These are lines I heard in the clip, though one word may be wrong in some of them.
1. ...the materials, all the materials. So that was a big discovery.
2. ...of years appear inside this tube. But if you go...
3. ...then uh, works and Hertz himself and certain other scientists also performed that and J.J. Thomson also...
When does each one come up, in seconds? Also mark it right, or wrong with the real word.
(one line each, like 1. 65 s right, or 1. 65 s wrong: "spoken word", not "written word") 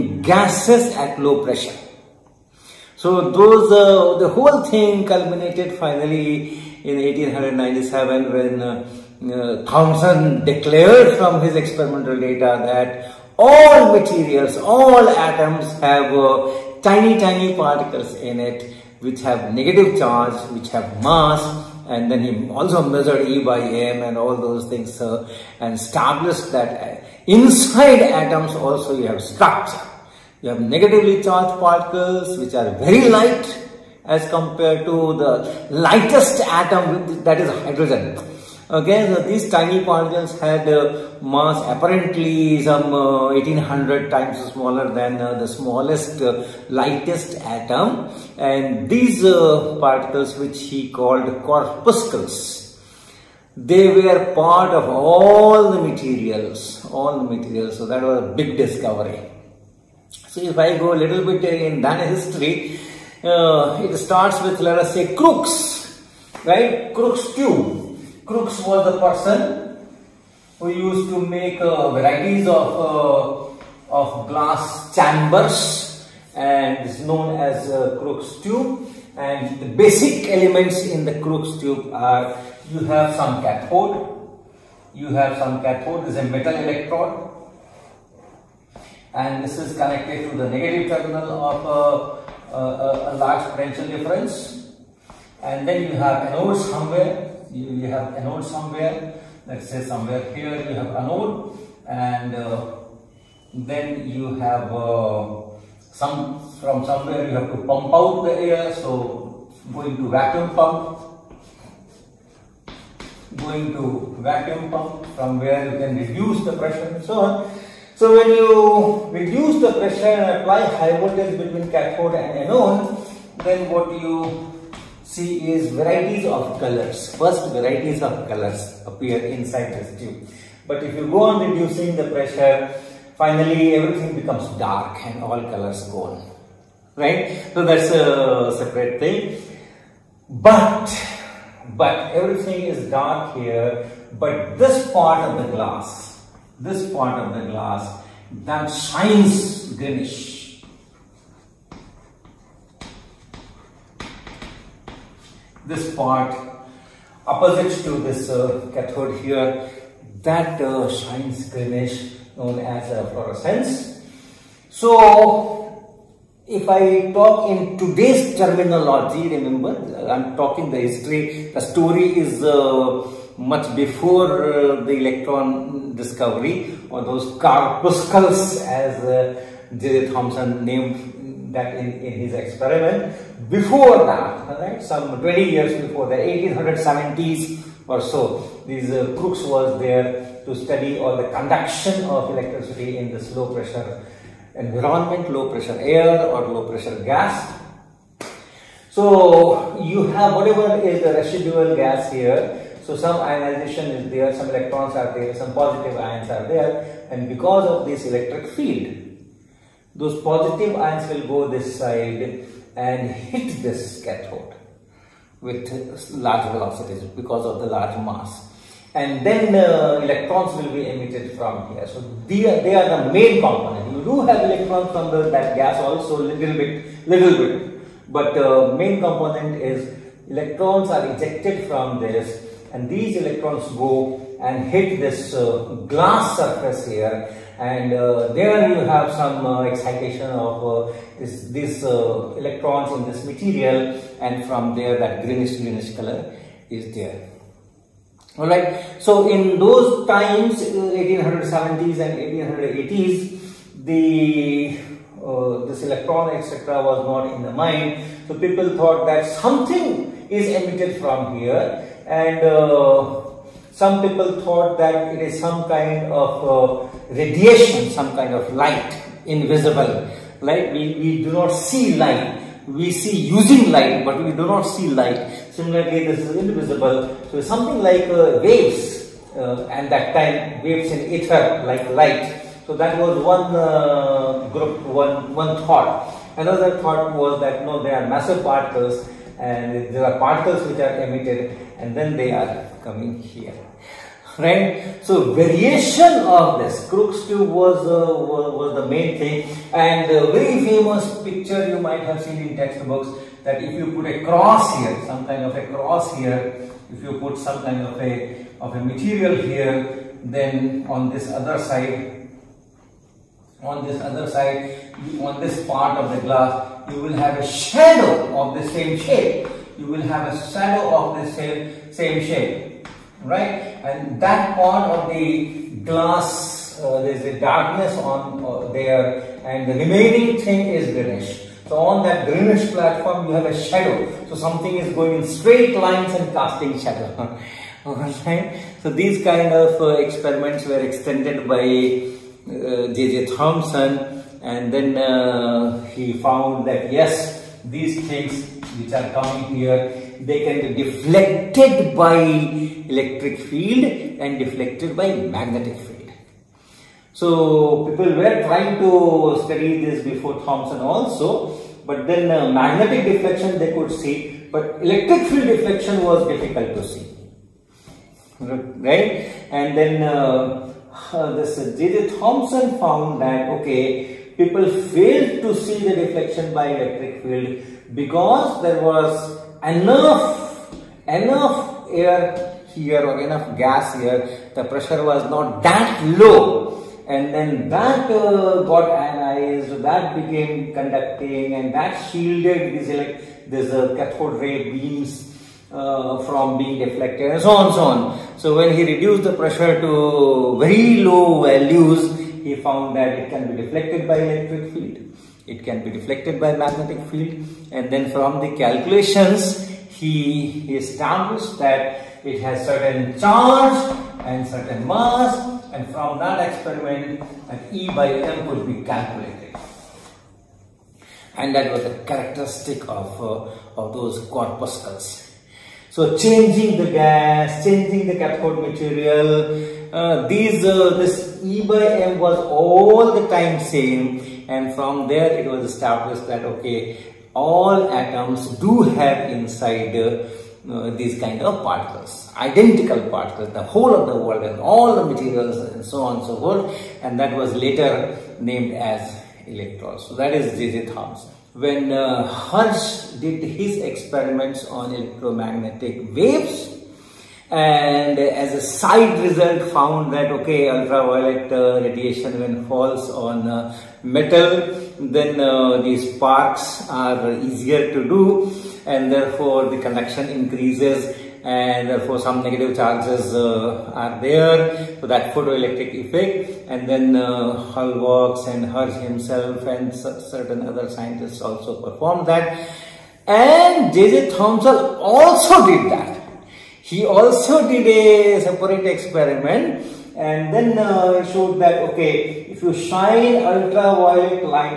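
1. 55 s right
2. 128 s wrong: "colors", not "years"
3. 476 s right.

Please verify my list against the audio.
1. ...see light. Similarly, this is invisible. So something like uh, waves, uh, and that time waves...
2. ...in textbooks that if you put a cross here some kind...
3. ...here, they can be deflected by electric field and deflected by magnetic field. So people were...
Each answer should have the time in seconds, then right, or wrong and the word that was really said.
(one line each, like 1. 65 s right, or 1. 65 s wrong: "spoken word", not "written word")
1. 274 s right
2. 302 s right
3. 349 s right.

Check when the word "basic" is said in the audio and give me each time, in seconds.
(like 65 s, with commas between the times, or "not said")
79 s.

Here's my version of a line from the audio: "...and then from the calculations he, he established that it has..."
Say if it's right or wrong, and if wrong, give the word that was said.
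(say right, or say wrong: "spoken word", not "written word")
right.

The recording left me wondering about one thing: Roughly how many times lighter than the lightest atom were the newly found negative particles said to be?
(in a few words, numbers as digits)
1800.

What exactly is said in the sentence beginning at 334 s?
So something is going in straight lines and casting shadow.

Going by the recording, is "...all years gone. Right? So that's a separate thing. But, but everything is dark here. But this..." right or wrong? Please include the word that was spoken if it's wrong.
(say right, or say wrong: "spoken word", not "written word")
wrong: "colors", not "years".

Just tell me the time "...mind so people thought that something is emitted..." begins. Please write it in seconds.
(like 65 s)
257 s.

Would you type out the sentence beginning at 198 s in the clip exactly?
So you have whatever is the residual gas here.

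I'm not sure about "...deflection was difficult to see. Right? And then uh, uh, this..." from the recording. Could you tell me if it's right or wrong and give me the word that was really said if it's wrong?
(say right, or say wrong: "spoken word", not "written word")
right.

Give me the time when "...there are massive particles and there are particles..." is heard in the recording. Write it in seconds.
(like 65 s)
287 s.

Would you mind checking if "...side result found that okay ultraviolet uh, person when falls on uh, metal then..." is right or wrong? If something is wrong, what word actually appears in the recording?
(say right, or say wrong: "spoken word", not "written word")
wrong: "radiation", not "person".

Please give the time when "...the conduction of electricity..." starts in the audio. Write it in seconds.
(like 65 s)
191 s.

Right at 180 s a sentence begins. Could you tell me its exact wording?
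Thomson named that in, in his experiment.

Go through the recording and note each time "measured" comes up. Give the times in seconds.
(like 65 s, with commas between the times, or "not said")
22 s.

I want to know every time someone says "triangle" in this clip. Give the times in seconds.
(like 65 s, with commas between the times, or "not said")
not said.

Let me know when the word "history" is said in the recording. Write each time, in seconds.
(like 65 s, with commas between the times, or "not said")
62 s, 170 s.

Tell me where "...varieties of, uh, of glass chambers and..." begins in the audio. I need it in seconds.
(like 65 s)
71 s.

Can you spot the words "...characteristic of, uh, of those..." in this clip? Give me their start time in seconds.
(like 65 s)
422 s.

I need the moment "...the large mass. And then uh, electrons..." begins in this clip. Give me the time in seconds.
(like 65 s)
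217 s.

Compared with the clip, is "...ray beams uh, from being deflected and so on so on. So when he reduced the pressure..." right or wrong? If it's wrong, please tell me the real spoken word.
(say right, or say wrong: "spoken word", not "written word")
right.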